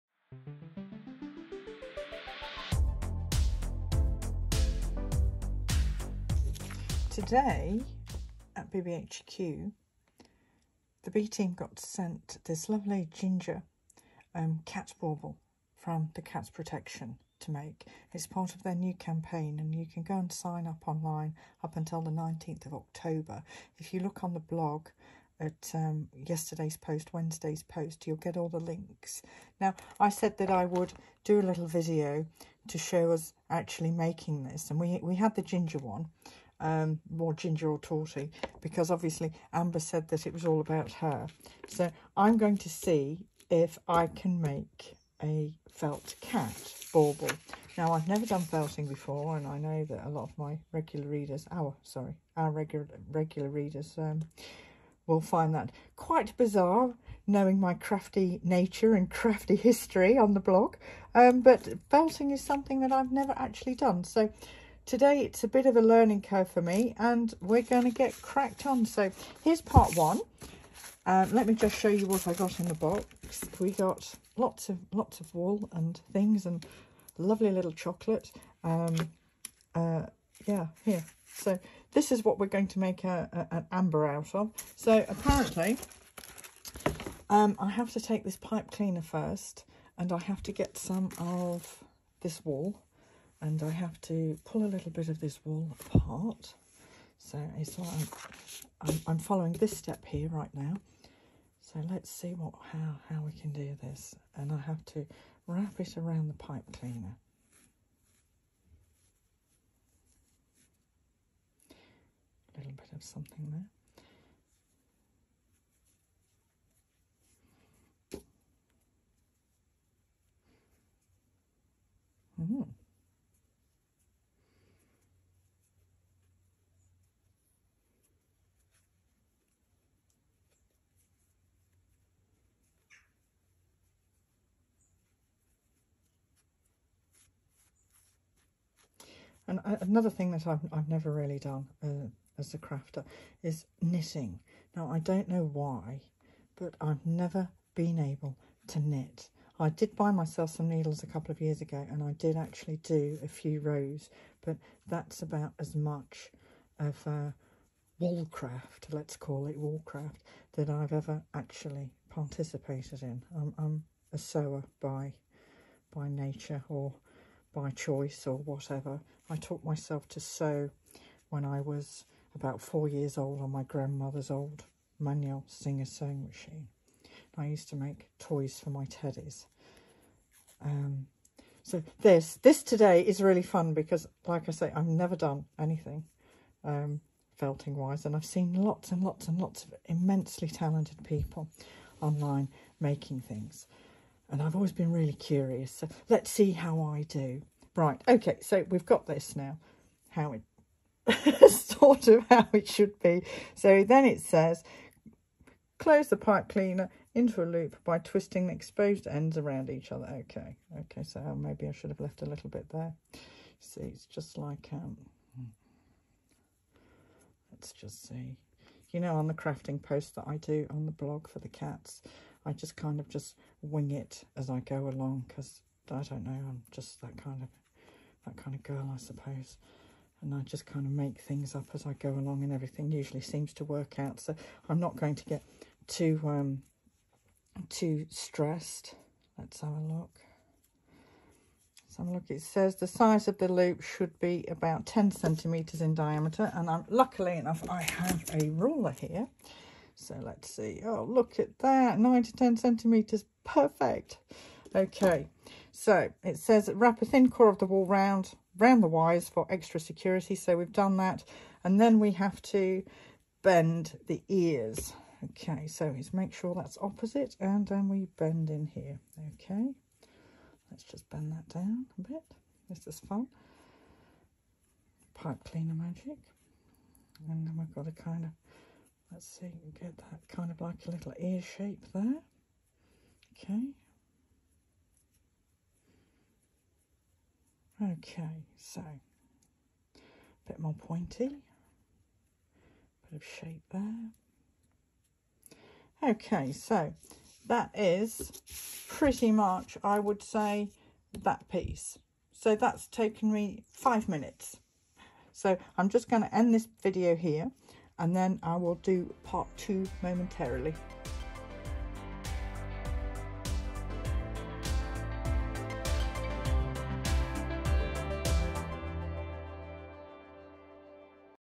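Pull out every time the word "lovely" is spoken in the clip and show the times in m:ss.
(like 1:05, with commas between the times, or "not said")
0:12, 1:17.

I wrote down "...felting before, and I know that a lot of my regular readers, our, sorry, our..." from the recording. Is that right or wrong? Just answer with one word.
right.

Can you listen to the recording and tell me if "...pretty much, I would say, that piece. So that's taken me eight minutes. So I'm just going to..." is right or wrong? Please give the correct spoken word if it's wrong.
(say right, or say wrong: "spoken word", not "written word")
wrong: "five", not "eight".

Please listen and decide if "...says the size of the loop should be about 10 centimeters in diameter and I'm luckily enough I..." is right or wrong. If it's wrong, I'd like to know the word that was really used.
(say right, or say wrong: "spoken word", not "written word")
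right.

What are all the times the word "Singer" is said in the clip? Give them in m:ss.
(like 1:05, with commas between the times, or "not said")
2:55.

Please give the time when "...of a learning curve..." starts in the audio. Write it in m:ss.
1:05.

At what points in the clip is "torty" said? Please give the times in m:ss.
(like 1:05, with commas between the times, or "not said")
0:37.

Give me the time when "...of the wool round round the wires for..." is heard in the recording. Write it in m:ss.
4:17.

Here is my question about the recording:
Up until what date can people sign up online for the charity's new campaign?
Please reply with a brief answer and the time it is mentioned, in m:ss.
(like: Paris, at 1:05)
19th of October, at 0:22.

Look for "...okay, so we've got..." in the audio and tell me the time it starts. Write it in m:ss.
3:18.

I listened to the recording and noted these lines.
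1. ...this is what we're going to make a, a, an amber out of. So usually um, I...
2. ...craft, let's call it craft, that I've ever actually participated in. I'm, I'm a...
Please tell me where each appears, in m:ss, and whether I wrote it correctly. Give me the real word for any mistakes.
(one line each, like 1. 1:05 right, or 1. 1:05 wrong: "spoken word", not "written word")
1. 1:21 wrong: "apparently", not "usually"
2. 2:38 right.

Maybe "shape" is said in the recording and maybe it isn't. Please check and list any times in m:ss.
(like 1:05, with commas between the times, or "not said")
4:41, 4:53.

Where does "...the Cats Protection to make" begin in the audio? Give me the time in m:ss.
0:16.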